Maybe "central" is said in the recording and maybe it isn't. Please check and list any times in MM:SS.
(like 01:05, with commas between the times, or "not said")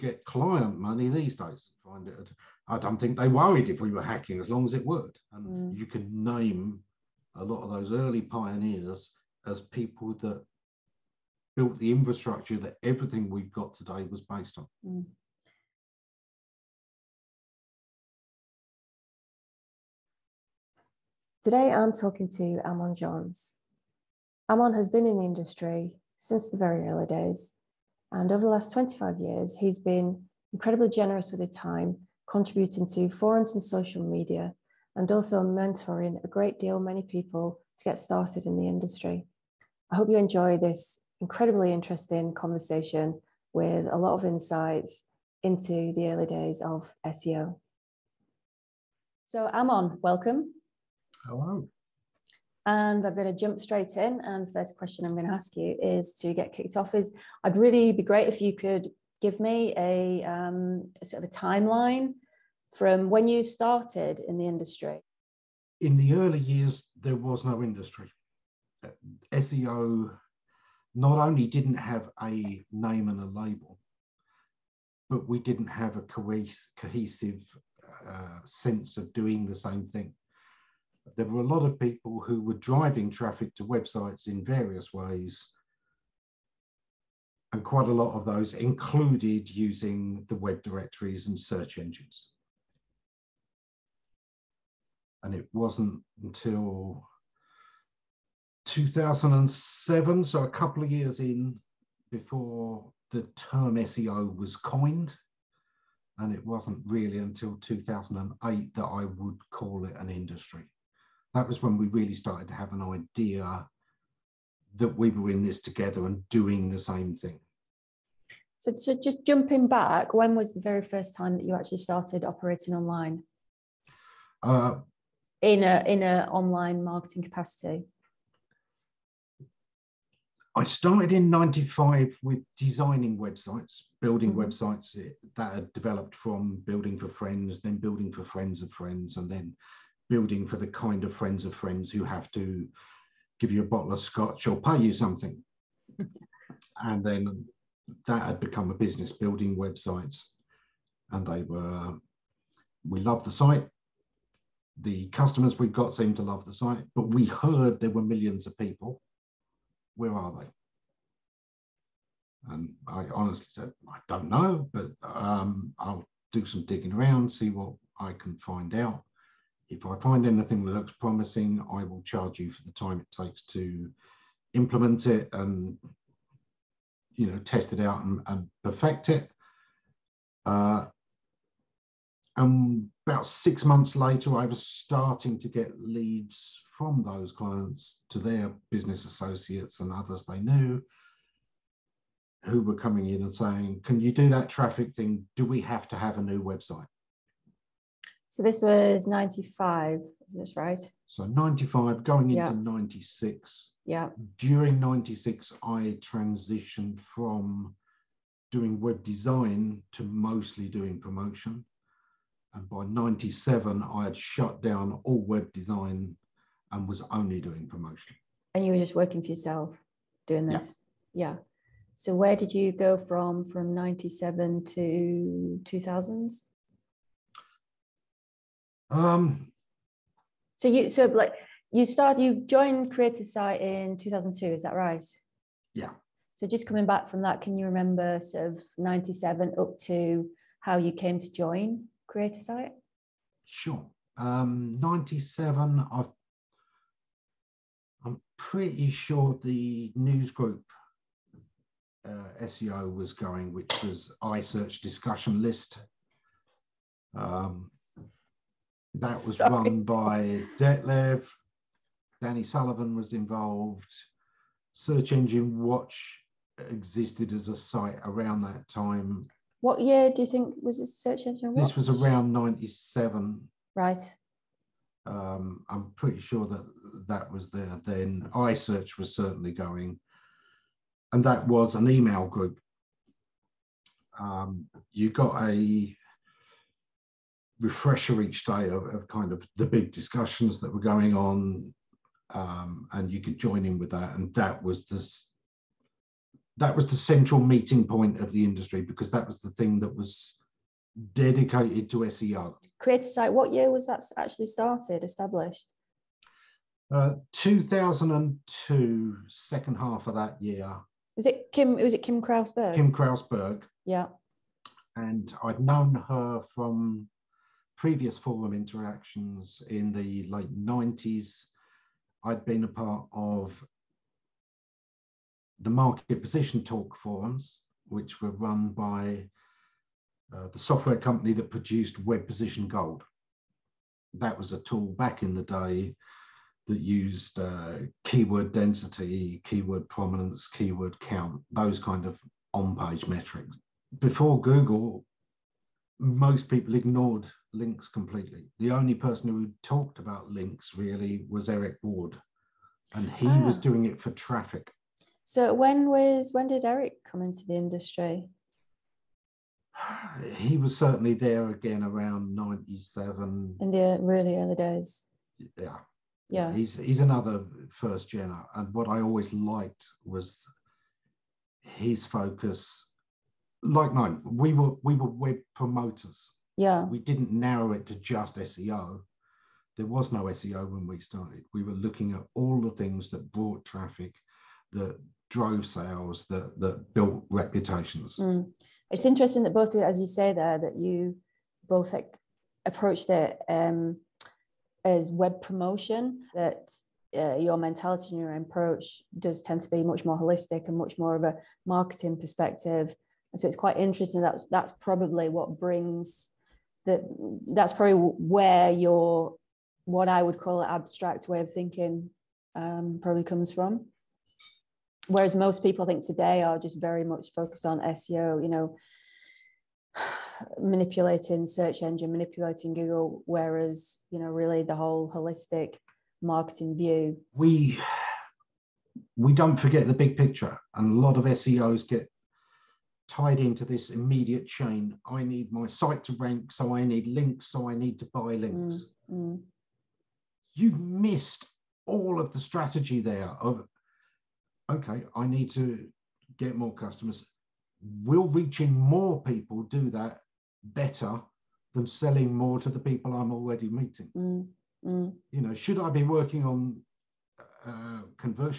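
04:56.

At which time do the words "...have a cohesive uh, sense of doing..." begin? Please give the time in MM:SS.
01:15.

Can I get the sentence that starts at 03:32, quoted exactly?
And by 97, I had shut down all web design and was only doing promotion.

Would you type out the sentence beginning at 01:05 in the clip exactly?
In the early years, there was no industry.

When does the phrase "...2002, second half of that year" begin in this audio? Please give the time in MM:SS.
05:07.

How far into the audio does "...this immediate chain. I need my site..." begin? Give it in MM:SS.
07:13.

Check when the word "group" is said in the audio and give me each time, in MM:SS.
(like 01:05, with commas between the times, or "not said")
04:10, 04:42.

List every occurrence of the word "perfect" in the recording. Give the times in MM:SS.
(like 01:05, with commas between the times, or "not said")
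02:58.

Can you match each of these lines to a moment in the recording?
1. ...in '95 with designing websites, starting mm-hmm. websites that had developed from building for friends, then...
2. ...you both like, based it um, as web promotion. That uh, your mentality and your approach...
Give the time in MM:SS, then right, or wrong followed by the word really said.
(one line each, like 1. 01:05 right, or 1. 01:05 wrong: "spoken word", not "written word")
1. 02:11 wrong: "building", not "starting"
2. 06:30 wrong: "approached", not "based".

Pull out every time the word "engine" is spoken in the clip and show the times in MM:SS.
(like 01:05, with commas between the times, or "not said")
01:31, 04:25, 04:31, 07:01.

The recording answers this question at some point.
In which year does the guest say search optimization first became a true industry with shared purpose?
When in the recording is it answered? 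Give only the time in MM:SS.
01:47.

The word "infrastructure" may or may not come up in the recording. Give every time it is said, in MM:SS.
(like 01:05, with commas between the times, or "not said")
00:11.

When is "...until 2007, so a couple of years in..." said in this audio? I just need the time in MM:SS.
01:36.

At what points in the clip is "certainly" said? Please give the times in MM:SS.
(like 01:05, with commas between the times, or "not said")
04:39, 06:00.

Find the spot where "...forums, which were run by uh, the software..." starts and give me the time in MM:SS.
05:27.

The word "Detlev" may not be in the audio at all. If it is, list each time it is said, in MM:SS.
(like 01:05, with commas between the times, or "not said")
04:20.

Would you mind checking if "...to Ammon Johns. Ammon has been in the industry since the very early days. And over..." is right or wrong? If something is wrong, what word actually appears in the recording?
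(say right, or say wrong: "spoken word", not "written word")
right.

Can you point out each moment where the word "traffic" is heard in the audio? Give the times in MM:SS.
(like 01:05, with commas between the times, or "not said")
01:23, 03:14, 05:54, 06:23.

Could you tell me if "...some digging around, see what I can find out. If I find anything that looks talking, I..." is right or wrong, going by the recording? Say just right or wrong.
wrong.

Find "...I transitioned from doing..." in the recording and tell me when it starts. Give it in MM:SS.
03:25.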